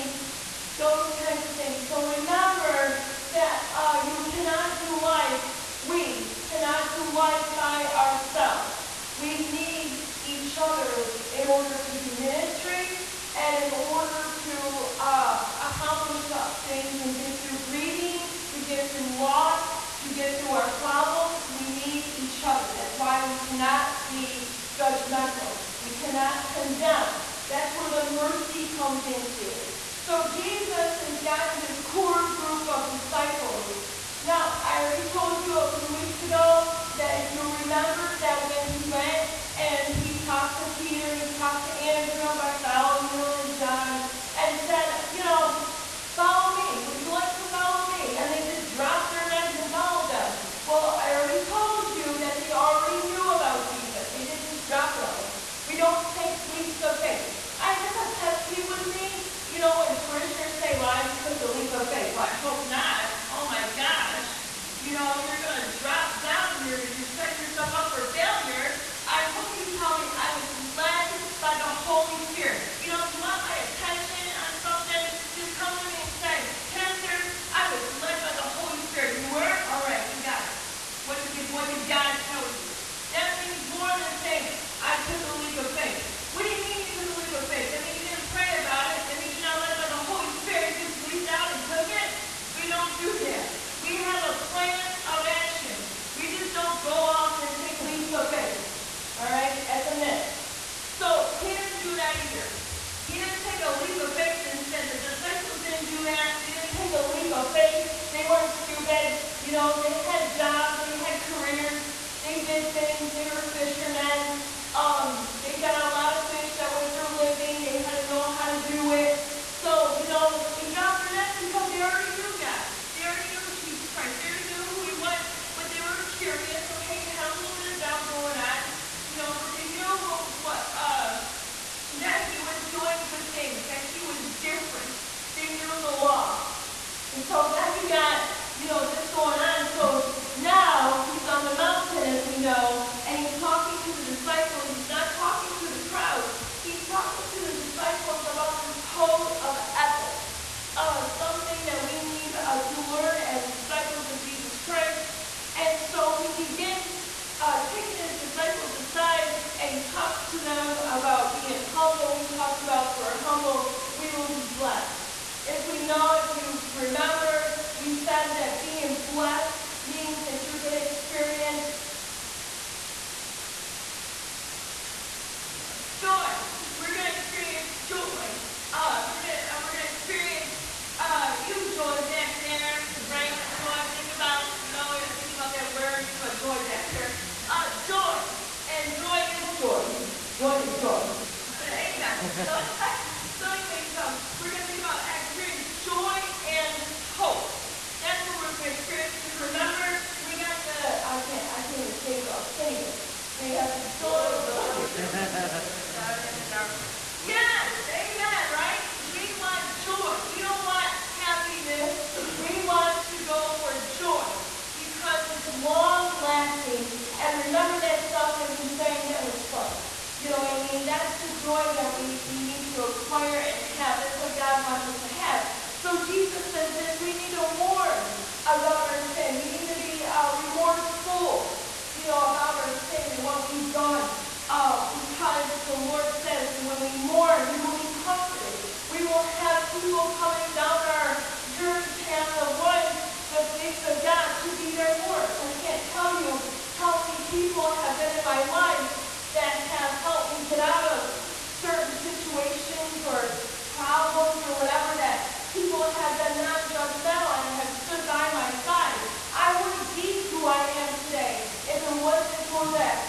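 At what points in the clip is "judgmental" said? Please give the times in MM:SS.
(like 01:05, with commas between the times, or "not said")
00:24, 04:16.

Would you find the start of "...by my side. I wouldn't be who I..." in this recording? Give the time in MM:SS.
04:18.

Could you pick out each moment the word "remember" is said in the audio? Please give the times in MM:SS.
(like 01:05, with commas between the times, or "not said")
00:37, 02:46, 03:19, 03:37.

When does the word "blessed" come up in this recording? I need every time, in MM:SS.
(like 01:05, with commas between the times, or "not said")
02:44, 02:49.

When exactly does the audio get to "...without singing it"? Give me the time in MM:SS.
03:22.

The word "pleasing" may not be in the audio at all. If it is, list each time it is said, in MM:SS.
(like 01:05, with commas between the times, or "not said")
not said.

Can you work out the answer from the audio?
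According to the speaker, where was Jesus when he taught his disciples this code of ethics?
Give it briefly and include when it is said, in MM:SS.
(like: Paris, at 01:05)
On the mountain, at 02:21.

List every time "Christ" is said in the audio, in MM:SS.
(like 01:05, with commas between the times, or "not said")
02:03, 02:34.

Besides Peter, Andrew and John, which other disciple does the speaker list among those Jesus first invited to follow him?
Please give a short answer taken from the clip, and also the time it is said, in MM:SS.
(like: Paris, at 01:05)
Bartholomew, at 00:42.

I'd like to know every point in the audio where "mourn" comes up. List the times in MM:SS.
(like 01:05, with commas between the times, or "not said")
03:47, 03:56.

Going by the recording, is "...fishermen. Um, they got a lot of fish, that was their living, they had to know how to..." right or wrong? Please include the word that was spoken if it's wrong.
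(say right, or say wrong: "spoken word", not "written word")
right.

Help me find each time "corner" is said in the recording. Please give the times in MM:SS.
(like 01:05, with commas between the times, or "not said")
not said.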